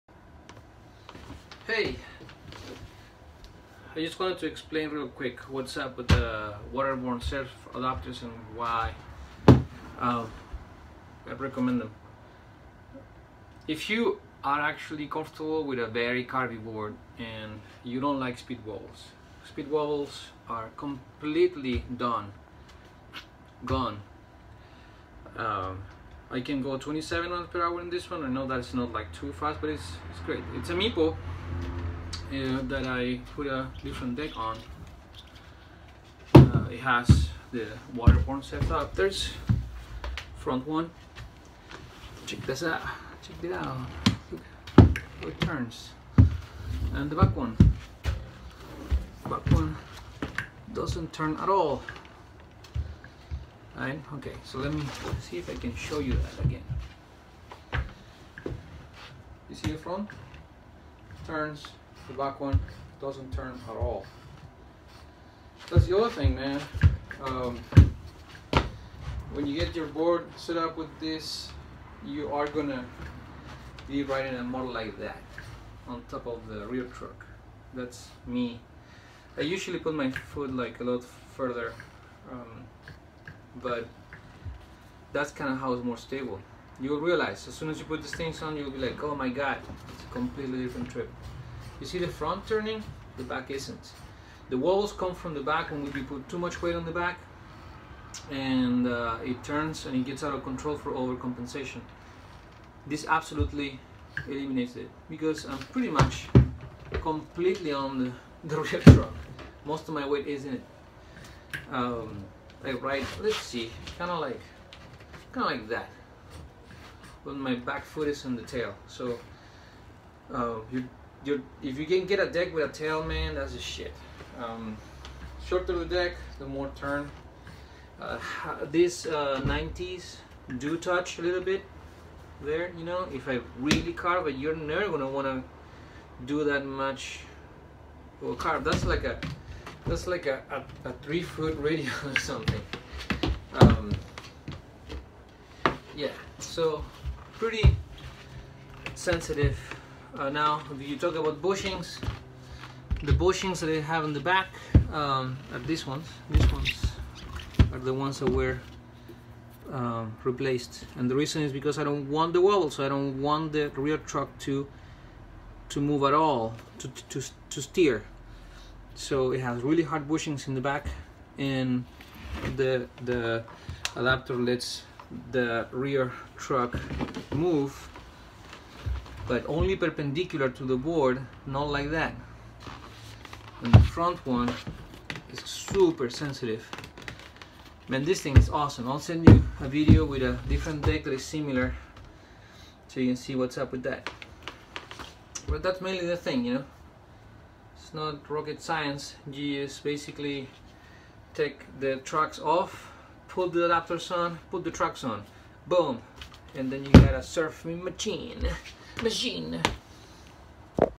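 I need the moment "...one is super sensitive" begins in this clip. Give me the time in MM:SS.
03:04.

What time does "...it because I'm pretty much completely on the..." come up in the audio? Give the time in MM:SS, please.
01:44.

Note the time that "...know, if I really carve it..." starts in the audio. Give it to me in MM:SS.
02:12.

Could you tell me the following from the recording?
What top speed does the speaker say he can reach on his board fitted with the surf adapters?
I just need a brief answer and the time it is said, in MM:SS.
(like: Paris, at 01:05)
27 miles per hour, at 00:26.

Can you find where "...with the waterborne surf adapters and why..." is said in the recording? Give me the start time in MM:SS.
00:05.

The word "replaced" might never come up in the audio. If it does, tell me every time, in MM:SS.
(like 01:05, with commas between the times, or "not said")
02:40.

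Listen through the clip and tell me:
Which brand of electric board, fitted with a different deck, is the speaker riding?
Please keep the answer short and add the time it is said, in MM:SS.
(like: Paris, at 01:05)
Meepo, at 00:30.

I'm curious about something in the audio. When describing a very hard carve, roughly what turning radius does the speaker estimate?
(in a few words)
3 foot.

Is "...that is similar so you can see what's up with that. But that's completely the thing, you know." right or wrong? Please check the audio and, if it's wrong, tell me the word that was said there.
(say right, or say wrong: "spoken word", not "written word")
wrong: "mainly", not "completely".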